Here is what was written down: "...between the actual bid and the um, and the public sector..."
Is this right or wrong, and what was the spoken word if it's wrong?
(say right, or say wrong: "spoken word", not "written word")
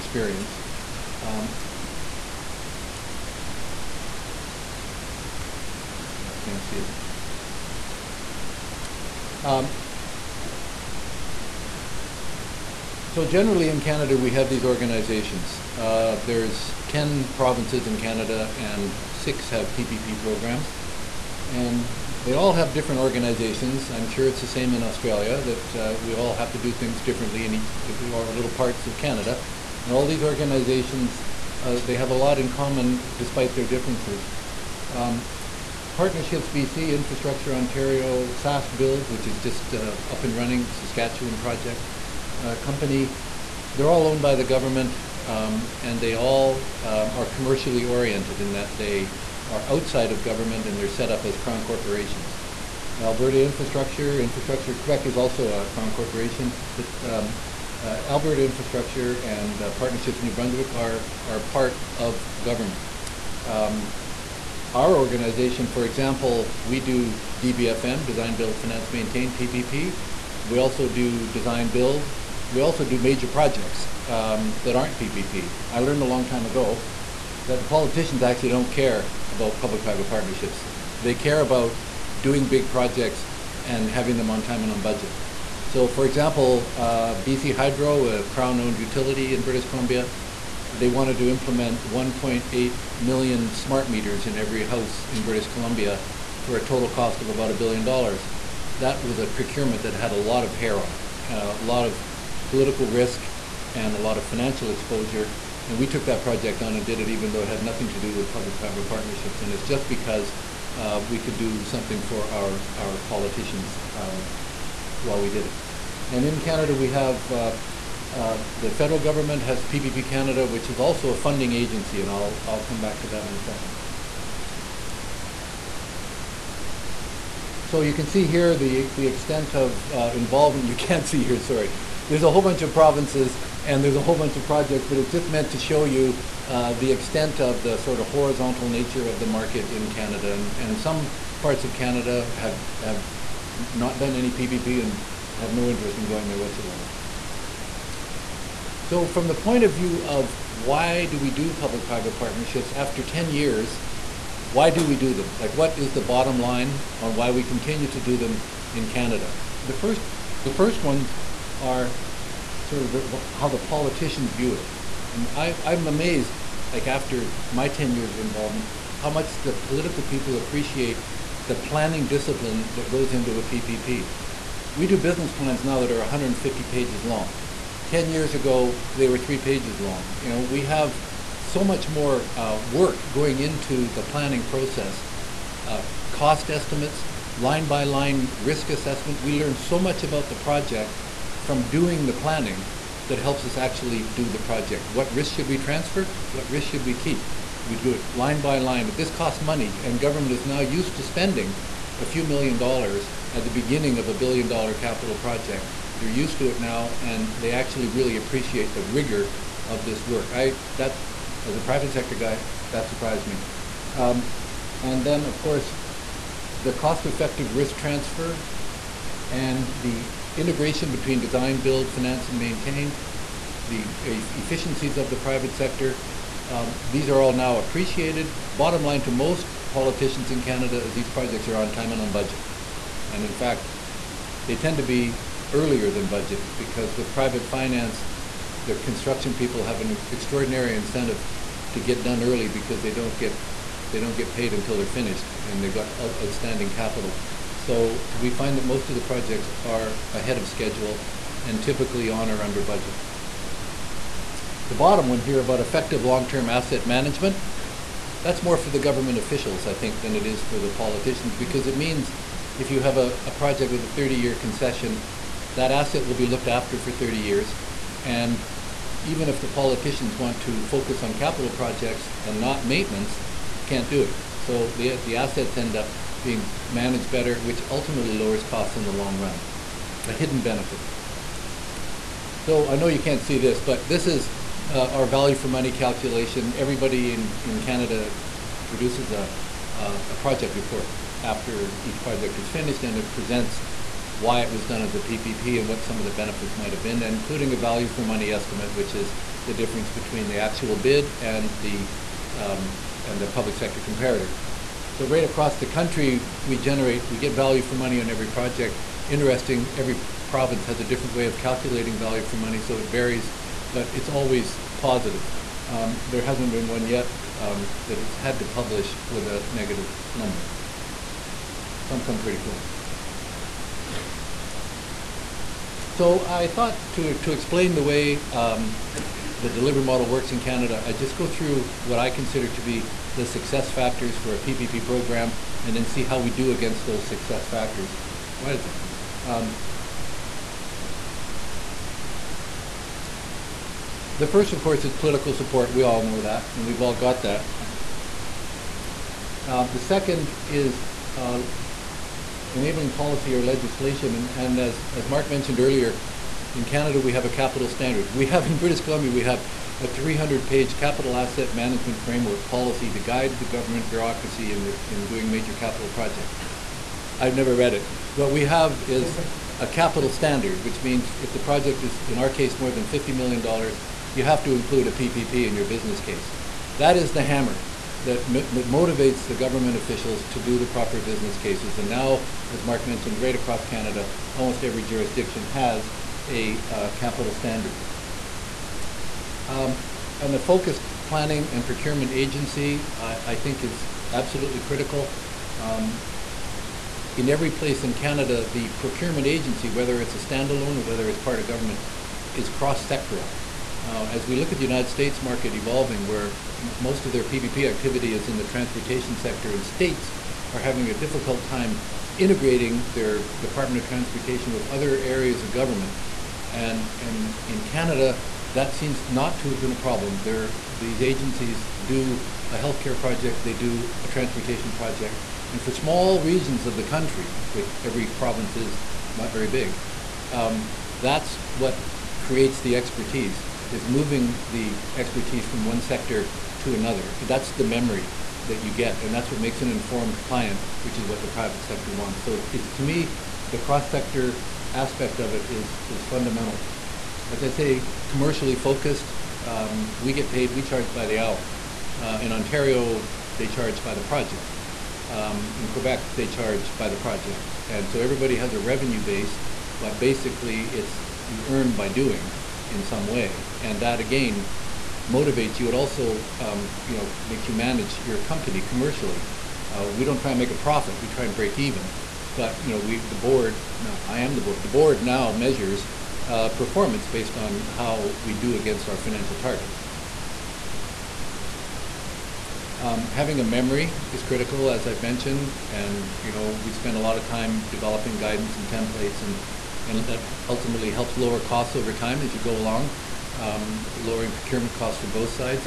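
right.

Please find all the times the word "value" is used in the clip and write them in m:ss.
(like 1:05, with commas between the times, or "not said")
4:45, 4:57, 5:07, 5:11.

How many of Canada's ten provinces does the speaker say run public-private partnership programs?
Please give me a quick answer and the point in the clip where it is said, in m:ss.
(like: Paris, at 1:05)
6, at 0:19.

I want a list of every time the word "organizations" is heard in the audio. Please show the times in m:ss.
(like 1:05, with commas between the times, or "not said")
0:14, 0:23, 0:30, 1:04.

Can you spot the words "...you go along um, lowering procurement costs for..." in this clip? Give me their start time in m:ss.
8:12.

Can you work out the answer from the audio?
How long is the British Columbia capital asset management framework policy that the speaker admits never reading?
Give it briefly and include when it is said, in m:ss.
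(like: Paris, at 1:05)
300 pages, at 5:59.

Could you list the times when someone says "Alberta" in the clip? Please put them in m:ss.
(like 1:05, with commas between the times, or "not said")
0:52, 0:58.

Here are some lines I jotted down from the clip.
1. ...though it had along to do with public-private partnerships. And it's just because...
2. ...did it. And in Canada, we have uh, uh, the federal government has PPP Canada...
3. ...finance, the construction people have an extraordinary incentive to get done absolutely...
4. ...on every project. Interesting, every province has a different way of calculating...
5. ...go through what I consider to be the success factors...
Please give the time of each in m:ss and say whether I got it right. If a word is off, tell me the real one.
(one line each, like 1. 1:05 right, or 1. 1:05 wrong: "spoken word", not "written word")
1. 1:47 wrong: "nothing", not "along"
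2. 1:55 right
3. 3:57 wrong: "early", not "absolutely"
4. 5:08 right
5. 5:31 right.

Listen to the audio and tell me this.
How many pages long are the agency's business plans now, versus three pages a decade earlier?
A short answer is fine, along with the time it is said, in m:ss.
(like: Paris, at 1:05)
150, at 2:55.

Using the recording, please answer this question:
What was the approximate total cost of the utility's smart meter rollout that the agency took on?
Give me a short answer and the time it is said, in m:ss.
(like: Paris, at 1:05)
About a billion dollars, at 1:37.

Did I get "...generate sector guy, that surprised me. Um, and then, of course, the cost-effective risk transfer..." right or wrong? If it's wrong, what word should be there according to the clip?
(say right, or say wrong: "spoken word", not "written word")
wrong: "private", not "generate".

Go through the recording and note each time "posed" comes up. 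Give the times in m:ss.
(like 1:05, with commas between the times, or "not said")
not said.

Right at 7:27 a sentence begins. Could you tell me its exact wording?
As I say, commercially focused, um, we get paid, we charge by the hour.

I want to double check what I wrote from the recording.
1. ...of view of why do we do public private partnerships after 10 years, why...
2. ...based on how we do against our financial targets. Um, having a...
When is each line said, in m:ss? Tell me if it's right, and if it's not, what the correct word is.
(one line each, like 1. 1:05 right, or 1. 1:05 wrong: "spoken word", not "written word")
1. 2:29 right
2. 7:57 right.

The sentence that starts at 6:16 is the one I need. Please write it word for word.
That is the hammer that, motivates the government officials to do the proper business cases.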